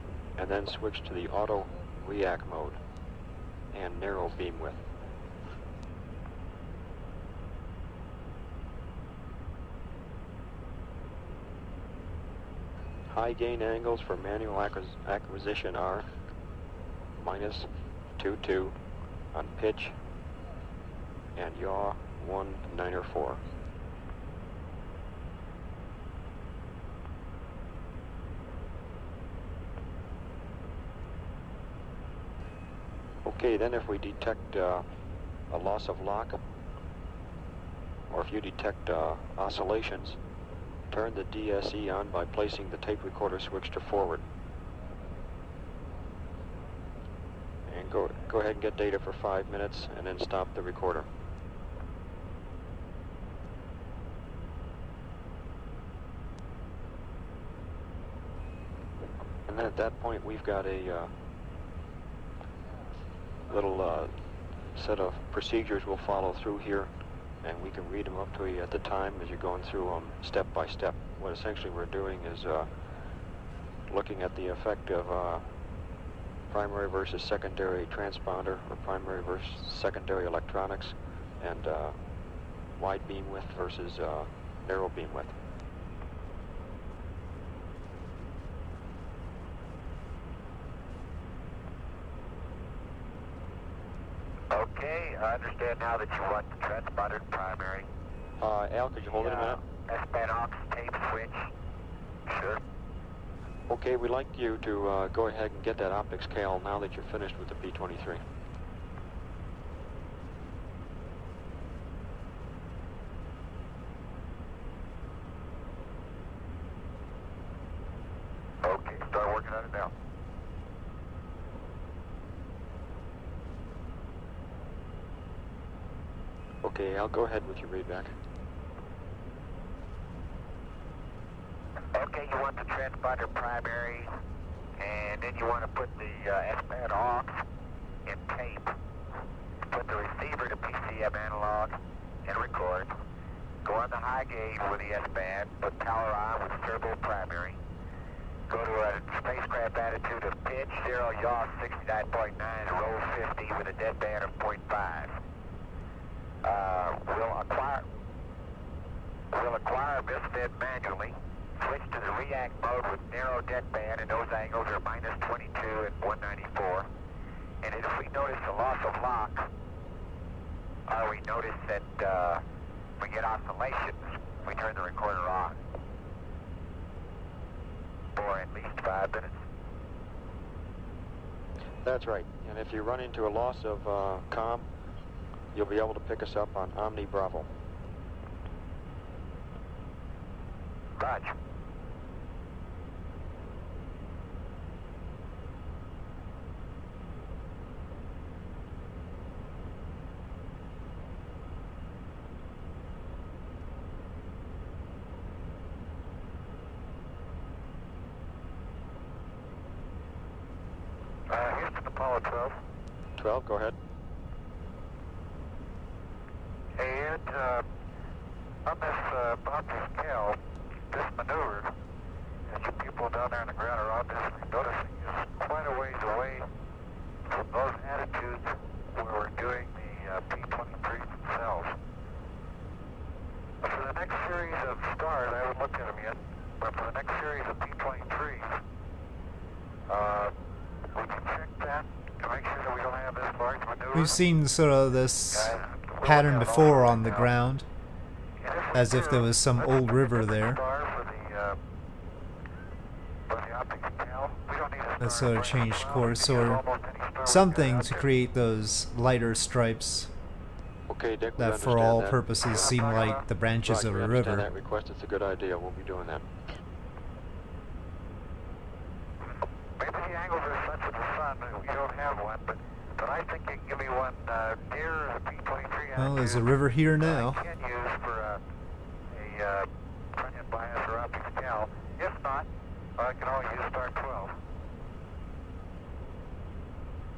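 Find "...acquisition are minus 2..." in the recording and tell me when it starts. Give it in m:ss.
0:15.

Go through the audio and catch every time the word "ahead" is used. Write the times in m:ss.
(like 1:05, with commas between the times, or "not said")
0:48, 1:45, 2:07, 3:33.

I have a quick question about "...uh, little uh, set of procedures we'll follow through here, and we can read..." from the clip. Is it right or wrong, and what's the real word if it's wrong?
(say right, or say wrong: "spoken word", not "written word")
right.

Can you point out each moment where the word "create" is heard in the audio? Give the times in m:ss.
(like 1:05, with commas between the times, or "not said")
4:17.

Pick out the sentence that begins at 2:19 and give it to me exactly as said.
Put the receiver to PCM analog and record.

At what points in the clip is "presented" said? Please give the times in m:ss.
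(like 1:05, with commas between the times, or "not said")
not said.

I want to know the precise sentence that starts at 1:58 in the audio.
Okay, start working on it now.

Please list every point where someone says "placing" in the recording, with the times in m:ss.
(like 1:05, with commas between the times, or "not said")
0:42.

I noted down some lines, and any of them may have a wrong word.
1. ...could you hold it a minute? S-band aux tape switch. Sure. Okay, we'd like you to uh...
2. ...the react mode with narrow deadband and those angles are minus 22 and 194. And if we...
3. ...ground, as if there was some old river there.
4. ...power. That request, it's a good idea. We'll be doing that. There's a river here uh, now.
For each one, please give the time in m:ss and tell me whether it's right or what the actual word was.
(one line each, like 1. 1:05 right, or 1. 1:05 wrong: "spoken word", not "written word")
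1. 1:38 right
2. 2:42 right
3. 4:07 right
4. 4:24 wrong: "river", not "power".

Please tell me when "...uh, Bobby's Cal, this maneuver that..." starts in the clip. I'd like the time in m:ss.
3:39.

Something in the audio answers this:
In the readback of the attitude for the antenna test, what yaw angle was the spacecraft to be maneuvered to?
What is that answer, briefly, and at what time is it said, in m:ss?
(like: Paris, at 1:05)
69.9, at 2:31.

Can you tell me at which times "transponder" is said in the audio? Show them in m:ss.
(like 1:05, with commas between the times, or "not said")
1:17, 1:36, 2:12.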